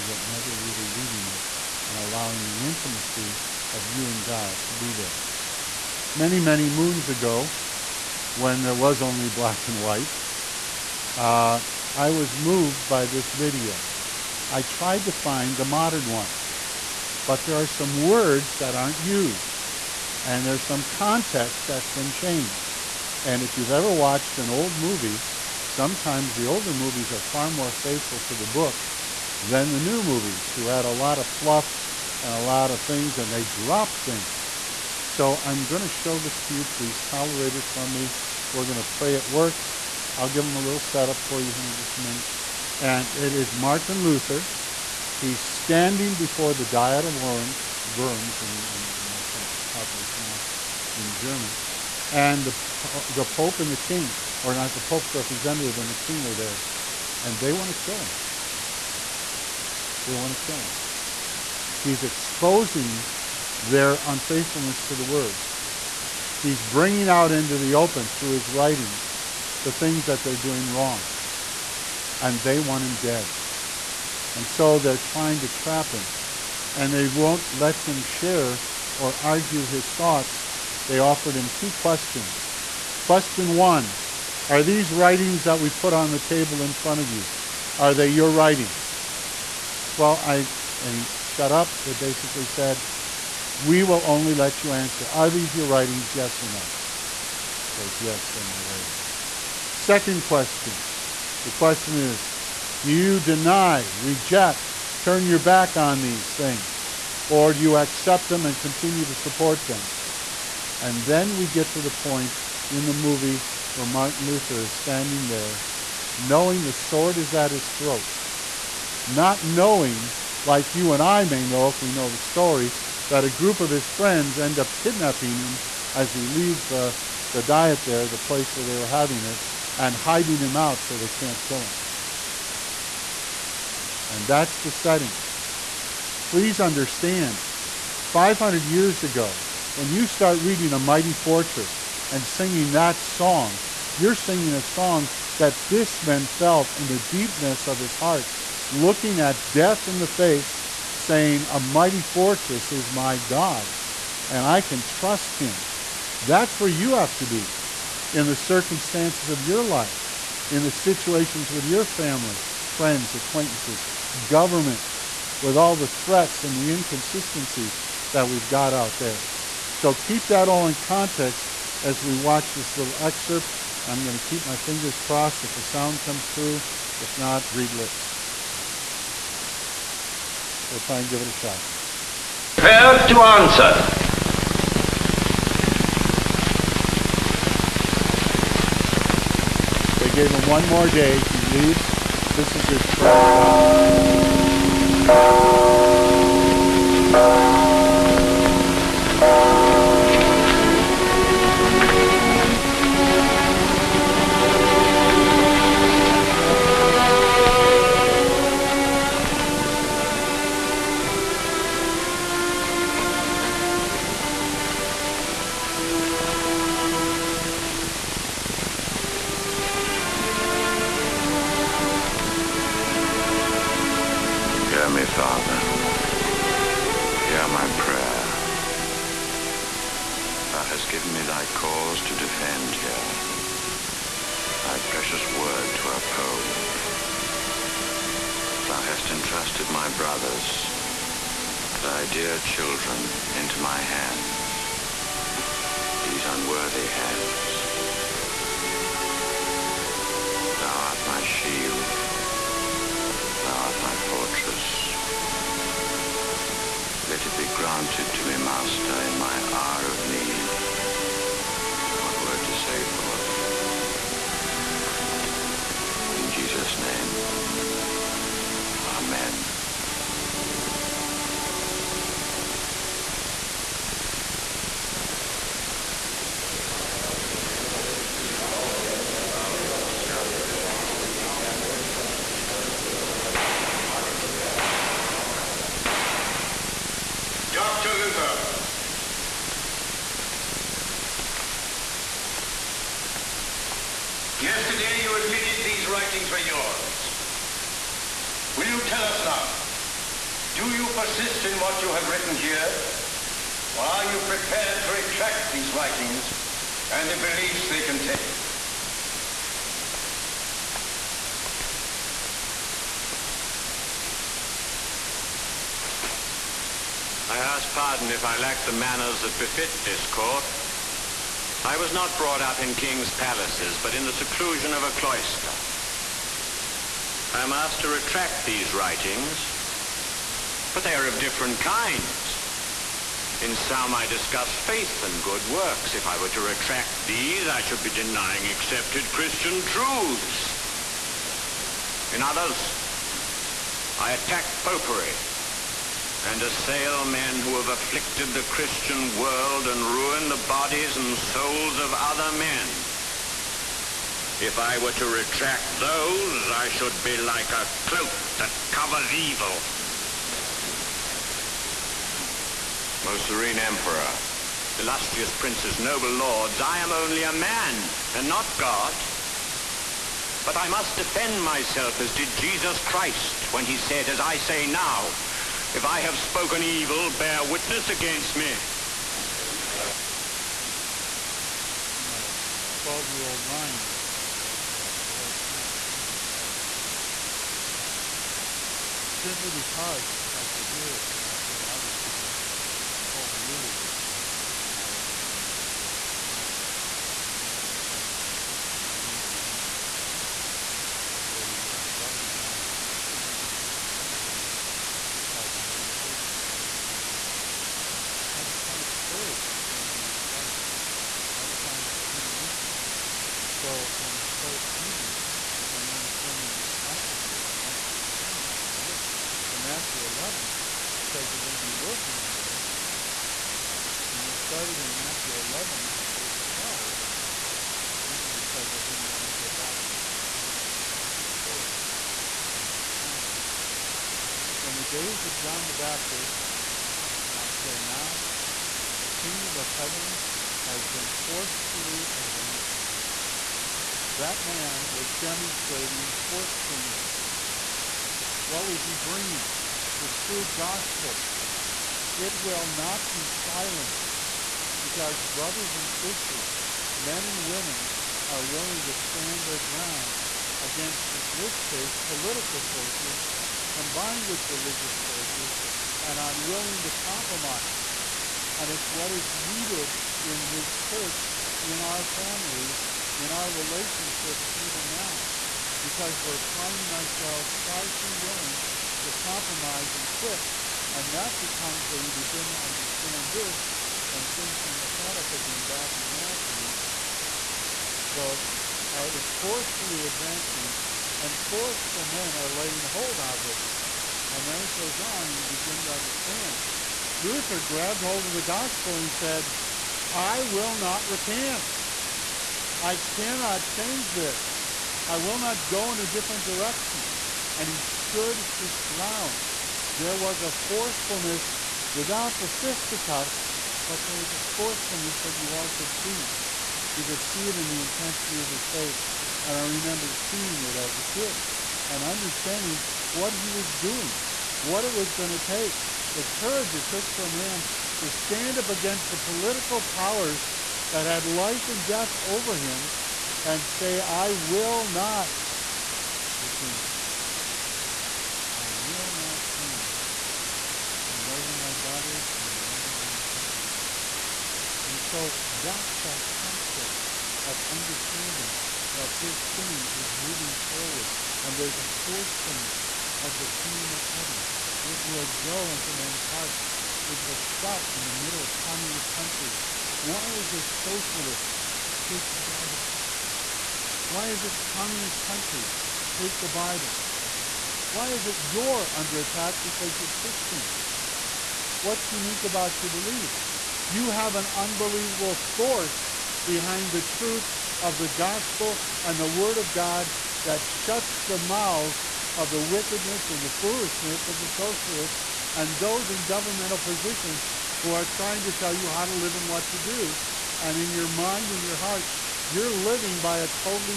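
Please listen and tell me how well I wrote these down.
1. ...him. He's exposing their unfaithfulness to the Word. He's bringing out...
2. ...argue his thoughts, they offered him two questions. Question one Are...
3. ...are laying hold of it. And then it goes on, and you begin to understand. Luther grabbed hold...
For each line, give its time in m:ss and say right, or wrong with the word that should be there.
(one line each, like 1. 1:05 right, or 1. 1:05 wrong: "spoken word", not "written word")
1. 1:00 right
2. 1:19 right
3. 8:12 right.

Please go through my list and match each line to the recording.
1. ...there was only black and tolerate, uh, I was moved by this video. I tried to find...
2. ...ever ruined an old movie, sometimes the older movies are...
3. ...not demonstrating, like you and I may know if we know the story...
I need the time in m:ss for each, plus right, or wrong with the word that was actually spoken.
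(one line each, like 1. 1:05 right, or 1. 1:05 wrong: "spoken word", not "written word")
1. 0:08 wrong: "white", not "tolerate"
2. 0:23 wrong: "watched", not "ruined"
3. 1:59 wrong: "knowing", not "demonstrating".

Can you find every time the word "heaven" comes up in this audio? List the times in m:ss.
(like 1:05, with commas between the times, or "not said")
7:19, 9:14.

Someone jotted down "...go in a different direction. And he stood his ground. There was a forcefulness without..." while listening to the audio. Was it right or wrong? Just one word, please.
right.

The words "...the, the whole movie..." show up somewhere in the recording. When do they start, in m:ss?
6:32.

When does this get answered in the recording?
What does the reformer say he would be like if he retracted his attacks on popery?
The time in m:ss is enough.
5:57.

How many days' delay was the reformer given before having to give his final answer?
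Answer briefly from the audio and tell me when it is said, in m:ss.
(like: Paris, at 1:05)
1, at 3:10.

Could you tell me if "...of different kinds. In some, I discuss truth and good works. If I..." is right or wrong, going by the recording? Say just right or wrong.
wrong.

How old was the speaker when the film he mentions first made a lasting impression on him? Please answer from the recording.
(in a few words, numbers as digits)
12.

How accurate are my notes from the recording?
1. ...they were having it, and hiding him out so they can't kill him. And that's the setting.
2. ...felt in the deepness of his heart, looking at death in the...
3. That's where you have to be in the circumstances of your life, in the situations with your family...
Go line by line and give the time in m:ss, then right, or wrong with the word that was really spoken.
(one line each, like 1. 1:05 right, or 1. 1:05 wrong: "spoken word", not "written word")
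1. 2:08 right
2. 2:26 right
3. 2:36 right.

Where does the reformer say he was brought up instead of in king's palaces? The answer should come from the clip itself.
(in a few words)
a cloister.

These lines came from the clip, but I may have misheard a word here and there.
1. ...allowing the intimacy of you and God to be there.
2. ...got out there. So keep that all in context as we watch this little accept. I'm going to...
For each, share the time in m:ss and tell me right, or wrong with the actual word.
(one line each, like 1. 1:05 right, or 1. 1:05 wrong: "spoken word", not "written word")
1. 0:01 right
2. 2:48 wrong: "excerpt", not "accept".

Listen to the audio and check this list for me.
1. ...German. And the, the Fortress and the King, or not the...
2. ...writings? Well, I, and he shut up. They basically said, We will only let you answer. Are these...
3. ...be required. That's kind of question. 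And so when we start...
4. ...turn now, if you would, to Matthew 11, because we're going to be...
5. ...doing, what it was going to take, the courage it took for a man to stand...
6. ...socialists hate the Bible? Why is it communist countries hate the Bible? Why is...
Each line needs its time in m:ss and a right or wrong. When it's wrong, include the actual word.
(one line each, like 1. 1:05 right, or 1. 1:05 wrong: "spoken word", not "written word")
1. 0:51 wrong: "Pope", not "Fortress"
2. 1:28 right
3. 6:49 wrong: "determination", not "question"
4. 6:58 right
5. 8:43 right
6. 9:20 right.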